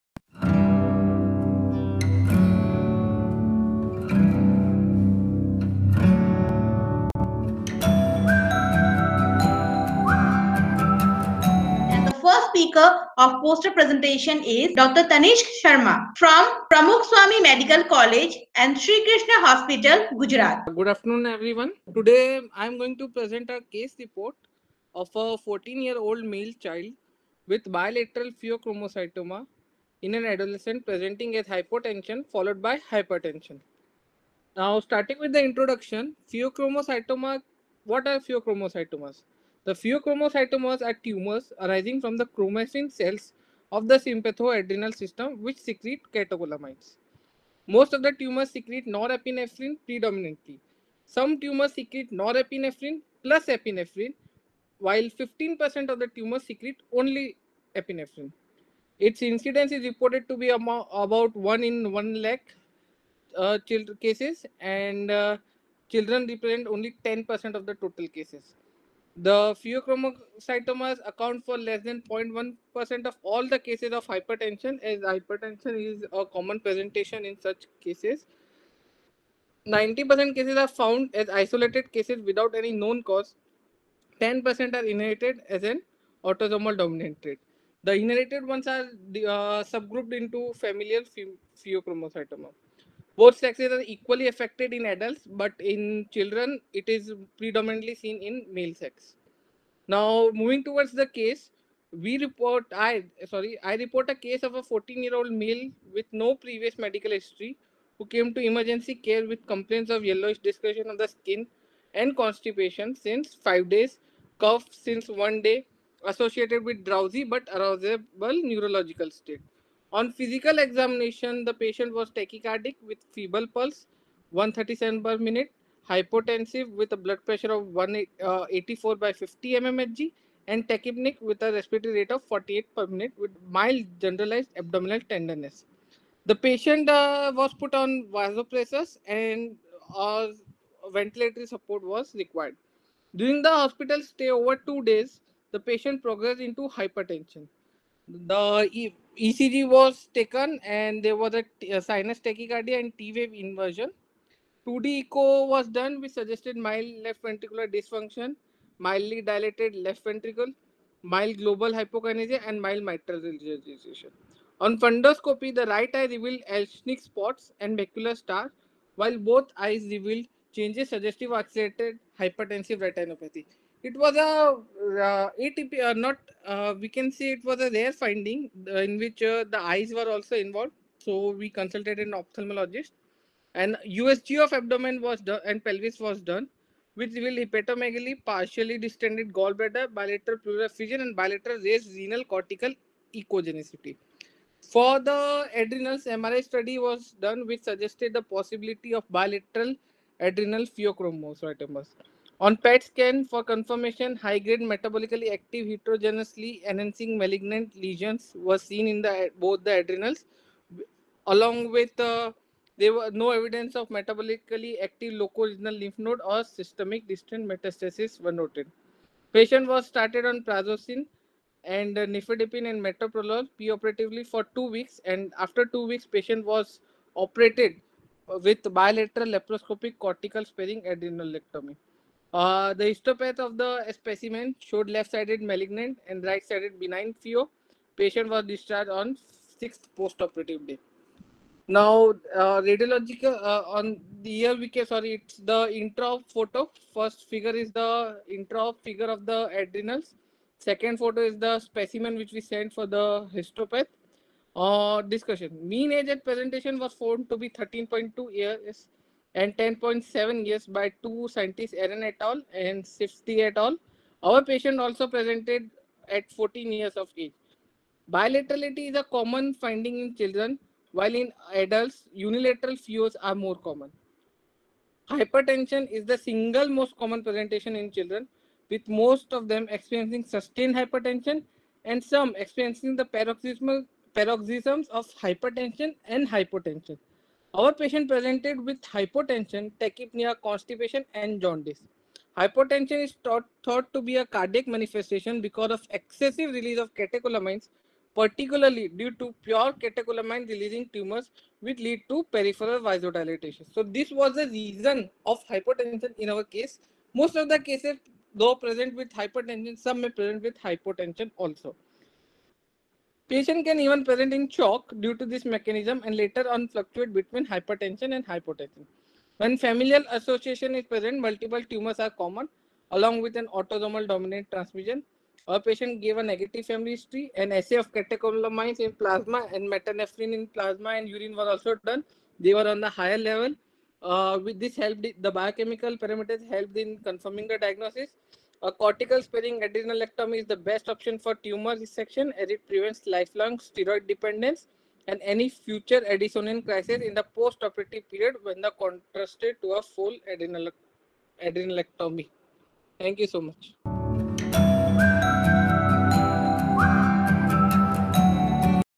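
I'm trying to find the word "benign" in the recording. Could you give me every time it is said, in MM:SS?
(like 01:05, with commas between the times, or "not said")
03:56.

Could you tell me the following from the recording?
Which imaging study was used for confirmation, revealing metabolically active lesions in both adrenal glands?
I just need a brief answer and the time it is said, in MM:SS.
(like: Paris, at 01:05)
PET scan, at 03:22.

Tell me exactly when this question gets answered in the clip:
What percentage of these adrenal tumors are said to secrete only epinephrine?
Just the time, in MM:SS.
00:55.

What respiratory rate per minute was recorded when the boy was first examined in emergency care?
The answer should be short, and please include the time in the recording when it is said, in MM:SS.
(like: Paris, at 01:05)
48, at 02:12.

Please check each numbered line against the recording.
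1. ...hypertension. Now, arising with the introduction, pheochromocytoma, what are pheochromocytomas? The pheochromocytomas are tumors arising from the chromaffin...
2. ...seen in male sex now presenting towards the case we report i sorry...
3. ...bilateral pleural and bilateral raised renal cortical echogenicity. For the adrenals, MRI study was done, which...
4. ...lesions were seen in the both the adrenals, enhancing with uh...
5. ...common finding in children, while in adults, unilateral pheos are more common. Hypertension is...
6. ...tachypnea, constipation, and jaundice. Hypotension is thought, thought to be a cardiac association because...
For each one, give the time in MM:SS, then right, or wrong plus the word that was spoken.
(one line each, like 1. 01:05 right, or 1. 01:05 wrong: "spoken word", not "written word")
1. 00:32 wrong: "starting", not "arising"
2. 01:38 wrong: "moving", not "presenting"
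3. 03:09 right
4. 03:27 wrong: "along", not "enhancing"
5. 04:29 right
6. 04:49 wrong: "manifestation", not "association".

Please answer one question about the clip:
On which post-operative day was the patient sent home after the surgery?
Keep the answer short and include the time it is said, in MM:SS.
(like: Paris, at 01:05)
6th, at 03:59.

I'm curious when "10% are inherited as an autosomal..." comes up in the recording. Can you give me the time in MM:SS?
01:24.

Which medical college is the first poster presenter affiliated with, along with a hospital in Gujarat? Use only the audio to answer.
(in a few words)
Pramukh Swami Medical College.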